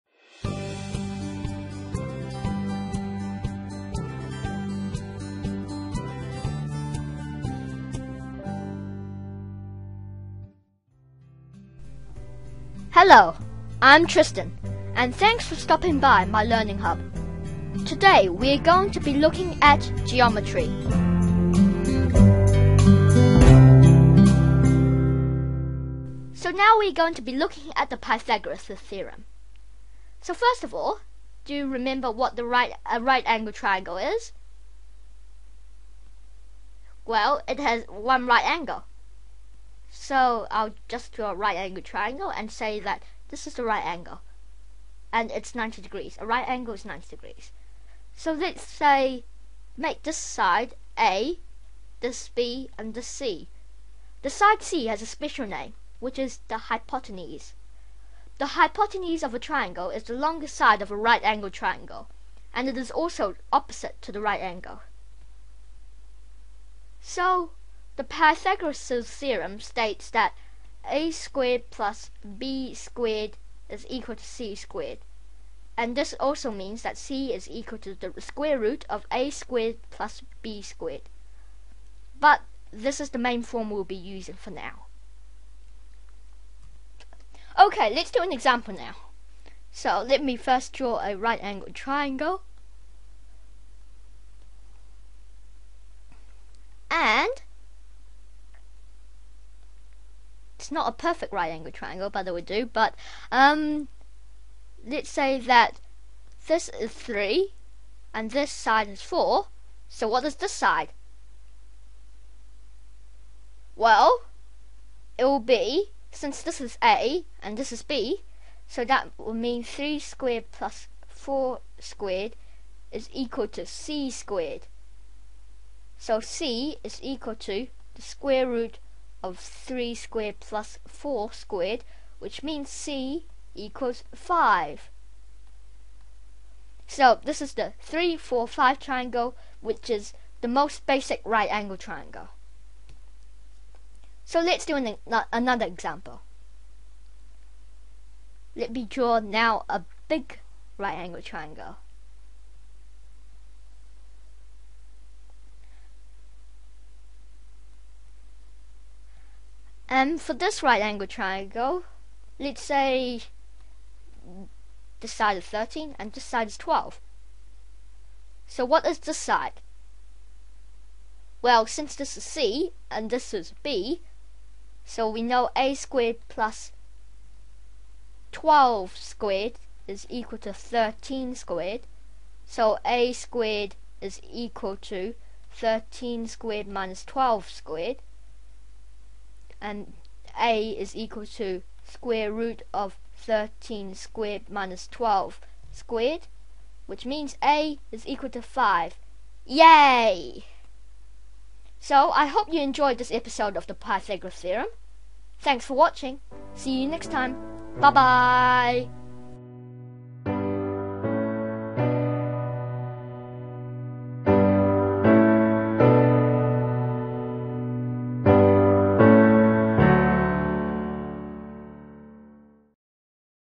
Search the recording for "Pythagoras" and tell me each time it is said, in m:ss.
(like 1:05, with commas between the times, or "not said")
0:27, 1:08, 3:23.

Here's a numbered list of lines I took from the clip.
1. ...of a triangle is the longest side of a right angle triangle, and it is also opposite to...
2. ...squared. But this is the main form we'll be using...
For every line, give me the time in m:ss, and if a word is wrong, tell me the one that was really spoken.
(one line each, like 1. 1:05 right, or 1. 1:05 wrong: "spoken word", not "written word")
1. 0:59 right
2. 1:20 right.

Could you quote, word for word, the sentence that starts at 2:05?
So C is equal to the square root of 3 squared plus 4 squared, which means C equals 5.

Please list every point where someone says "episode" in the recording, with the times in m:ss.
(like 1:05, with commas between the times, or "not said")
3:23.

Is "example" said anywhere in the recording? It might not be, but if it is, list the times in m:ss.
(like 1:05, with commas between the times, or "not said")
1:28, 2:25.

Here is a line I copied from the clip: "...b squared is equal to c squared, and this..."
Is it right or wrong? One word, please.
right.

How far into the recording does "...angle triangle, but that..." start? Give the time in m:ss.
1:41.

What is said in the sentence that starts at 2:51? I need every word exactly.
Well, since this is C and this is B, so we know A squared plus 12 squared is equal to 13 squared.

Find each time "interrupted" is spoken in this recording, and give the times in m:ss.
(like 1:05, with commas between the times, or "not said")
not said.